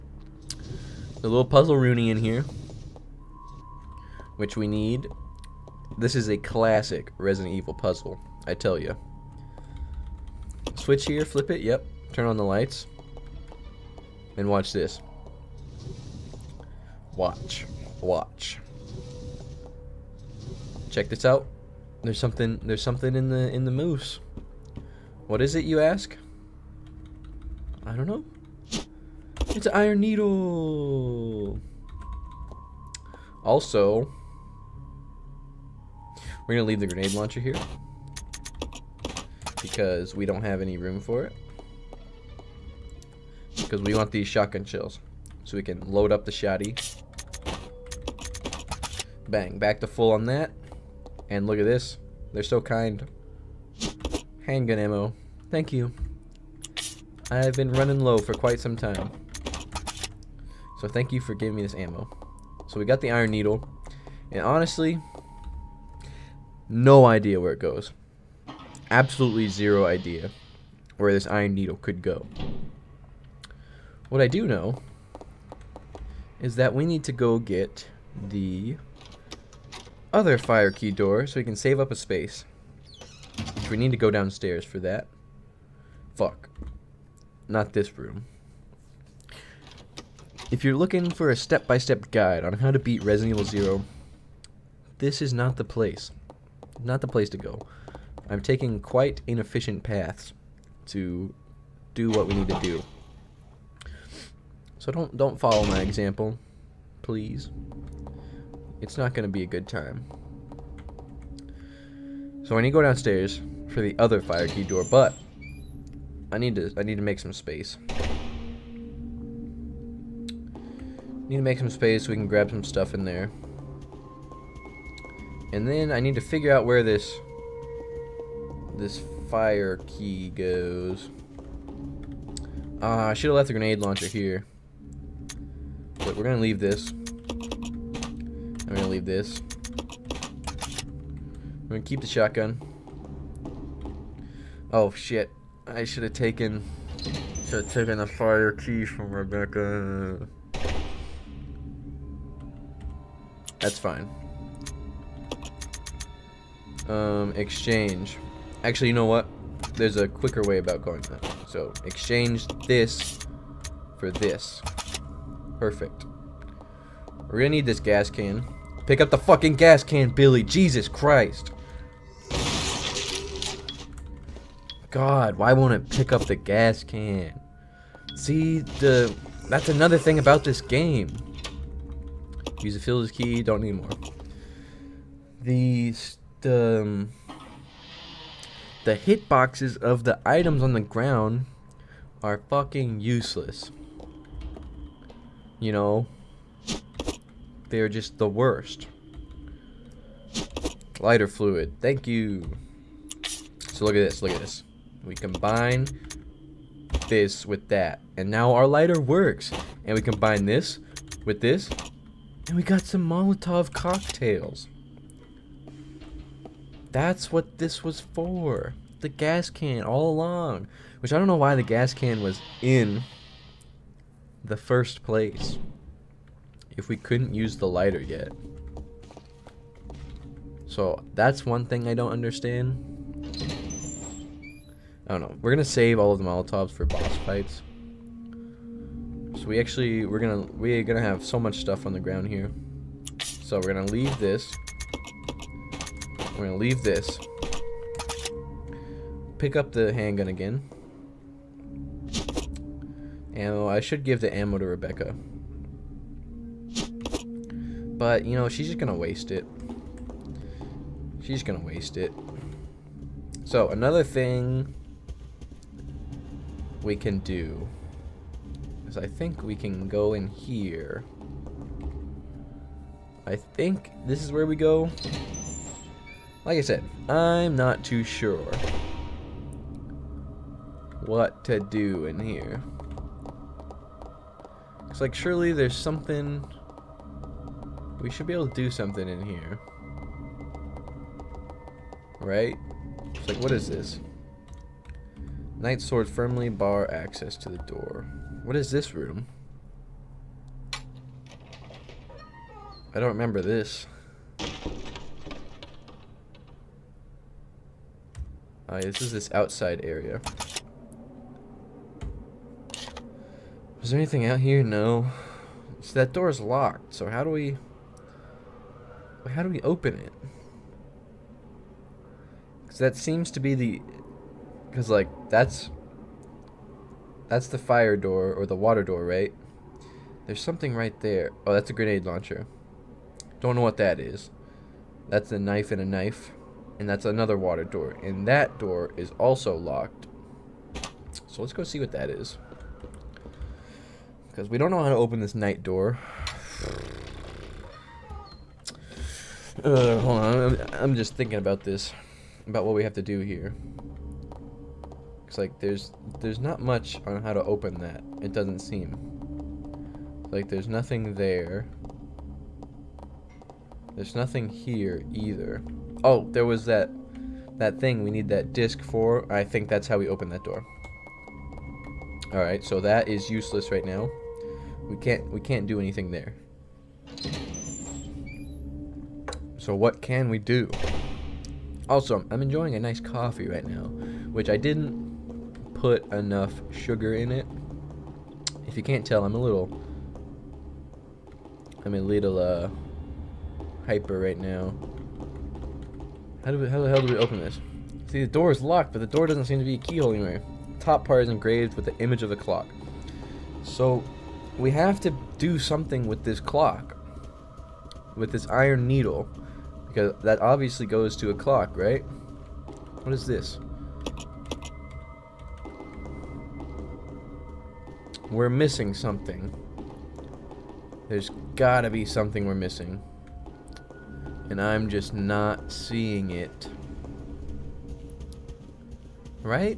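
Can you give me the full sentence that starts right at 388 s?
If you can't tell, I'm a little I'm a little uh hyper right now.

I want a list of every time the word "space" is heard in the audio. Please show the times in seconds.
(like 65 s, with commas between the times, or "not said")
81 s, 117 s, 121 s.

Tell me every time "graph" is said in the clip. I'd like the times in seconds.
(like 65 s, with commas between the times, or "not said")
not said.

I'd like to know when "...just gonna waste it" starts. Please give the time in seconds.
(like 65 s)
258 s.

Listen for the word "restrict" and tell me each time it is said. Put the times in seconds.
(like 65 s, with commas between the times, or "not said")
not said.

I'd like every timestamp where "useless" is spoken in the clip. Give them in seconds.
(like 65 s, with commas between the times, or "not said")
193 s, 373 s.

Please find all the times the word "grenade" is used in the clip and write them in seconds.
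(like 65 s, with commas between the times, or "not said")
36 s, 133 s, 331 s.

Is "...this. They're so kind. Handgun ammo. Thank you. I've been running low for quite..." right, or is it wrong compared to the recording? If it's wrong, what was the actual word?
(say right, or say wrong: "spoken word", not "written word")
right.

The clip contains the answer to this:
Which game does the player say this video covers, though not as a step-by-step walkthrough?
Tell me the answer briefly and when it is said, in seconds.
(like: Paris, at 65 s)
Resident Evil 0, at 93 s.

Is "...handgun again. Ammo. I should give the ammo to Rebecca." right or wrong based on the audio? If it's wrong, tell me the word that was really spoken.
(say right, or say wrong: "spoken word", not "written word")
right.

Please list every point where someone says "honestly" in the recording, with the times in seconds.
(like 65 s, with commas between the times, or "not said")
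64 s.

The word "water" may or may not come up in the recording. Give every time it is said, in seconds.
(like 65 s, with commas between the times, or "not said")
328 s, 337 s.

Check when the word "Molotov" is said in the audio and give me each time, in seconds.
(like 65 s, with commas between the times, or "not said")
213 s, 236 s.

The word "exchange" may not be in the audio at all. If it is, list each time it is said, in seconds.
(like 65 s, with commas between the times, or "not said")
157 s, 161 s.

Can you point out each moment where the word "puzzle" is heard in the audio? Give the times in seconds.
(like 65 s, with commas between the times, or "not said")
1 s, 7 s.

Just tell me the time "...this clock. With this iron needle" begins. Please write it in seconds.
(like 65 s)
406 s.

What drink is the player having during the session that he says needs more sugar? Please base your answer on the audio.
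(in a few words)
Coffee.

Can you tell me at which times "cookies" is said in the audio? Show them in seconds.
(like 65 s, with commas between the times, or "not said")
not said.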